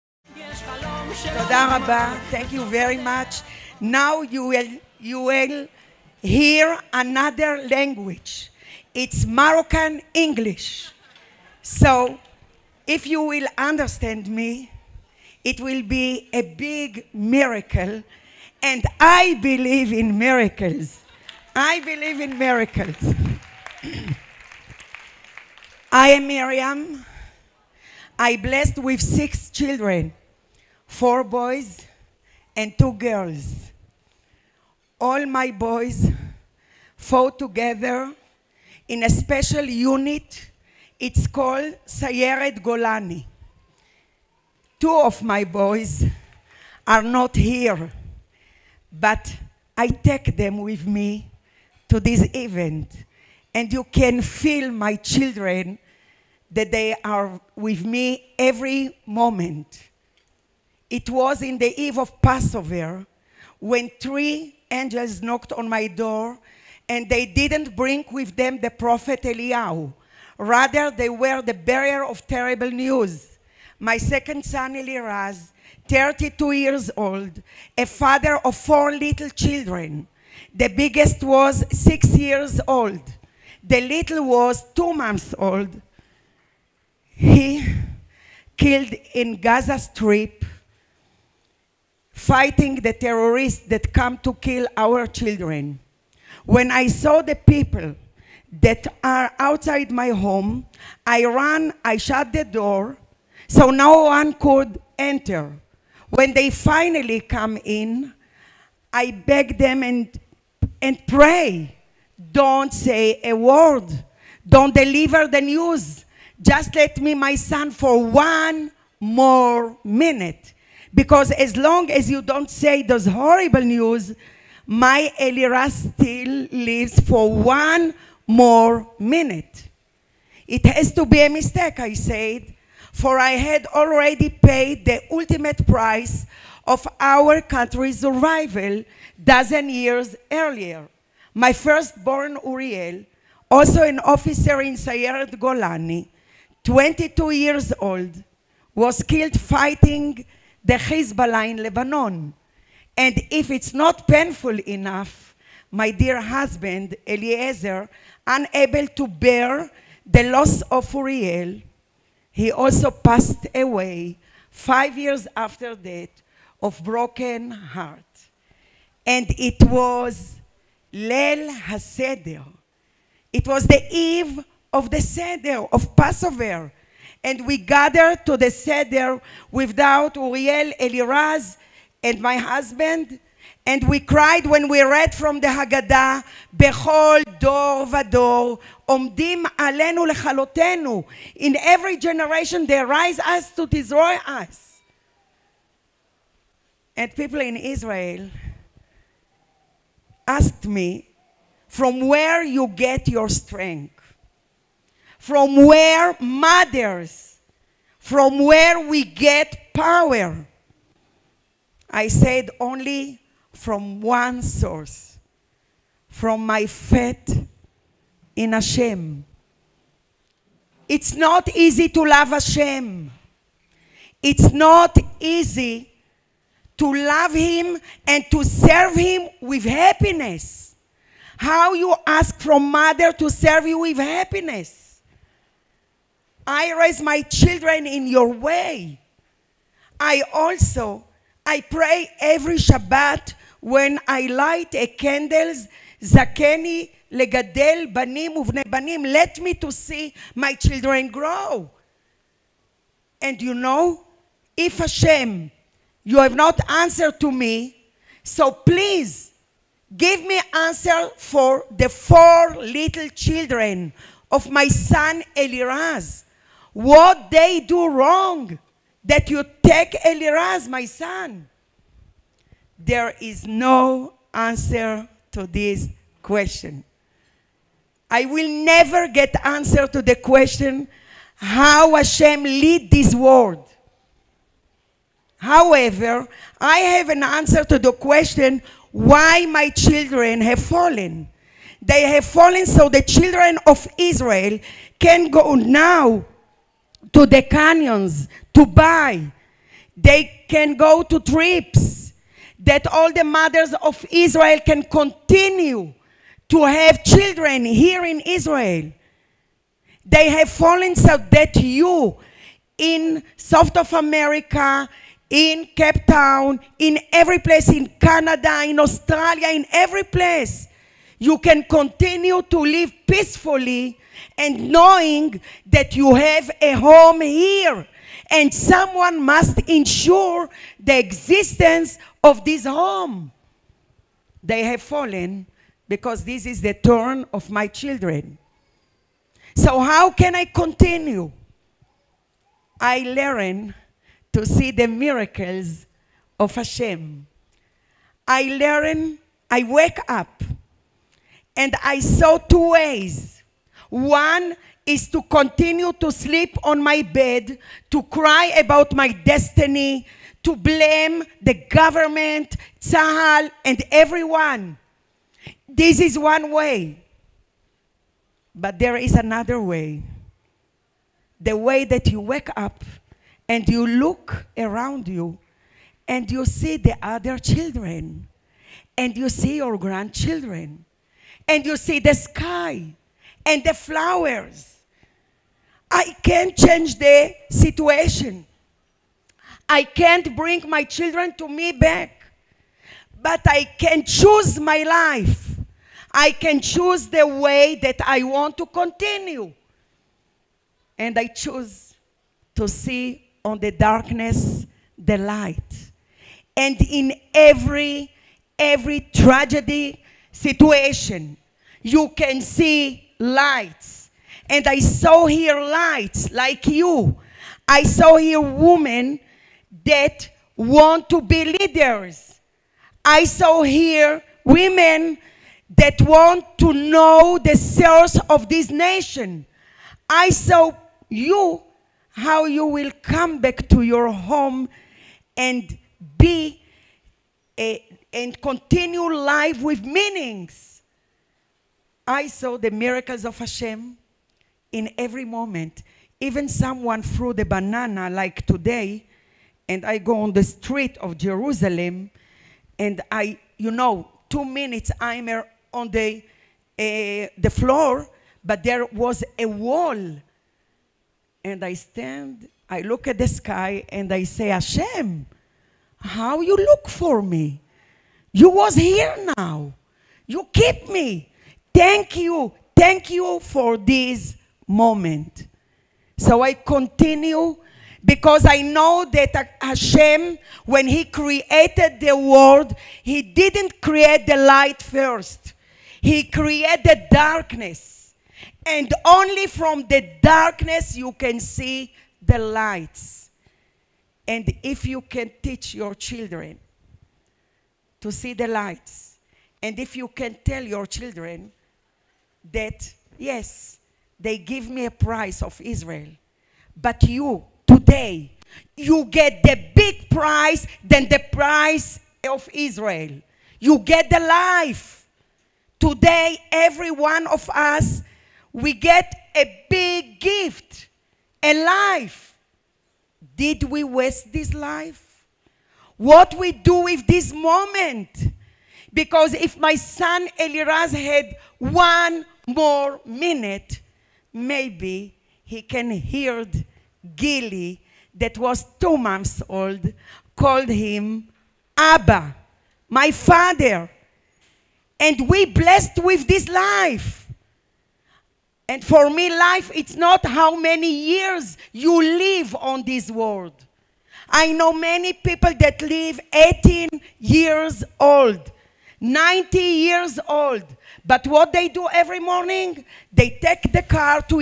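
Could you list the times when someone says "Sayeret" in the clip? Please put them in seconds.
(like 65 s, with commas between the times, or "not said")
41 s, 144 s.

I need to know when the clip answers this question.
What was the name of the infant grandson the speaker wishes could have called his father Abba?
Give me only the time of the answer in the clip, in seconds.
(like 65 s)
537 s.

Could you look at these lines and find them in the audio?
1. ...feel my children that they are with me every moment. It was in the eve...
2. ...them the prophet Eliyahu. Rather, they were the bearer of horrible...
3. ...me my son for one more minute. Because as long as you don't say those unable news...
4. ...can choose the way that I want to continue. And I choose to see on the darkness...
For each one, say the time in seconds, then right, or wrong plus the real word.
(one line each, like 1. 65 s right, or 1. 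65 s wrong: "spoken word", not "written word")
1. 54 s right
2. 68 s wrong: "terrible", not "horrible"
3. 116 s wrong: "horrible", not "unable"
4. 396 s right.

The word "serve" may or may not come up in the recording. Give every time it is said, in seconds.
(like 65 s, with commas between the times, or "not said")
228 s, 233 s.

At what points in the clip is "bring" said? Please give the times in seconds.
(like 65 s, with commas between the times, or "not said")
67 s, 390 s.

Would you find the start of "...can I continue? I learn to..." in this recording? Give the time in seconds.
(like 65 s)
340 s.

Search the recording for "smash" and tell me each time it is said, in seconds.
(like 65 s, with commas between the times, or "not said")
not said.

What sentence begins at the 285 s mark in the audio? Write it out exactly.
However, I have an answer to the question why my children have fallen.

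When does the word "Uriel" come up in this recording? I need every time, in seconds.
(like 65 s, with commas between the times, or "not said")
142 s, 160 s, 180 s.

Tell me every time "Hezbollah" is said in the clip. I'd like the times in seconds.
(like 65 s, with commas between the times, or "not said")
150 s.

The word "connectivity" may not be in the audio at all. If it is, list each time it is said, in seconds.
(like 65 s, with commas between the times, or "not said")
not said.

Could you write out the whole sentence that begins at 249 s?
Let me to see my children grow.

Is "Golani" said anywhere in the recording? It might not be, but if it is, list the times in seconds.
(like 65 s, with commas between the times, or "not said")
42 s, 145 s.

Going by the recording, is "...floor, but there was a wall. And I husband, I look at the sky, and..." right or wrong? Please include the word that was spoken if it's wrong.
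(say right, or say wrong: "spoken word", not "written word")
wrong: "stand", not "husband".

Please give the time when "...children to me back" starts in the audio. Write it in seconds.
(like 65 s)
390 s.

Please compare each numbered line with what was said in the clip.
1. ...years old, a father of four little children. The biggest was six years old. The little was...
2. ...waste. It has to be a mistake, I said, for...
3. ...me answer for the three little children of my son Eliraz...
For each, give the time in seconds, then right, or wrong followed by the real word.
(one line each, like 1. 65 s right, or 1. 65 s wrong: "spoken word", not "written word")
1. 76 s right
2. 128 s wrong: "minute", not "waste"
3. 260 s wrong: "four", not "three".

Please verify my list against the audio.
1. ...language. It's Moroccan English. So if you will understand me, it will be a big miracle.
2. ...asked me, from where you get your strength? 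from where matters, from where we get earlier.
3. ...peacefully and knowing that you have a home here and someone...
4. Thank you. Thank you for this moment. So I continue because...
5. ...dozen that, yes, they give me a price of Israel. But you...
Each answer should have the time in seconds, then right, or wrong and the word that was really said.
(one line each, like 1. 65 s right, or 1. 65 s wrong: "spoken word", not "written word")
1. 7 s right
2. 200 s wrong: "power", not "earlier"
3. 323 s right
4. 471 s right
5. 500 s wrong: "children", not "dozen".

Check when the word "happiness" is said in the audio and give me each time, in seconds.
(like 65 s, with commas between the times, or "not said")
229 s, 233 s.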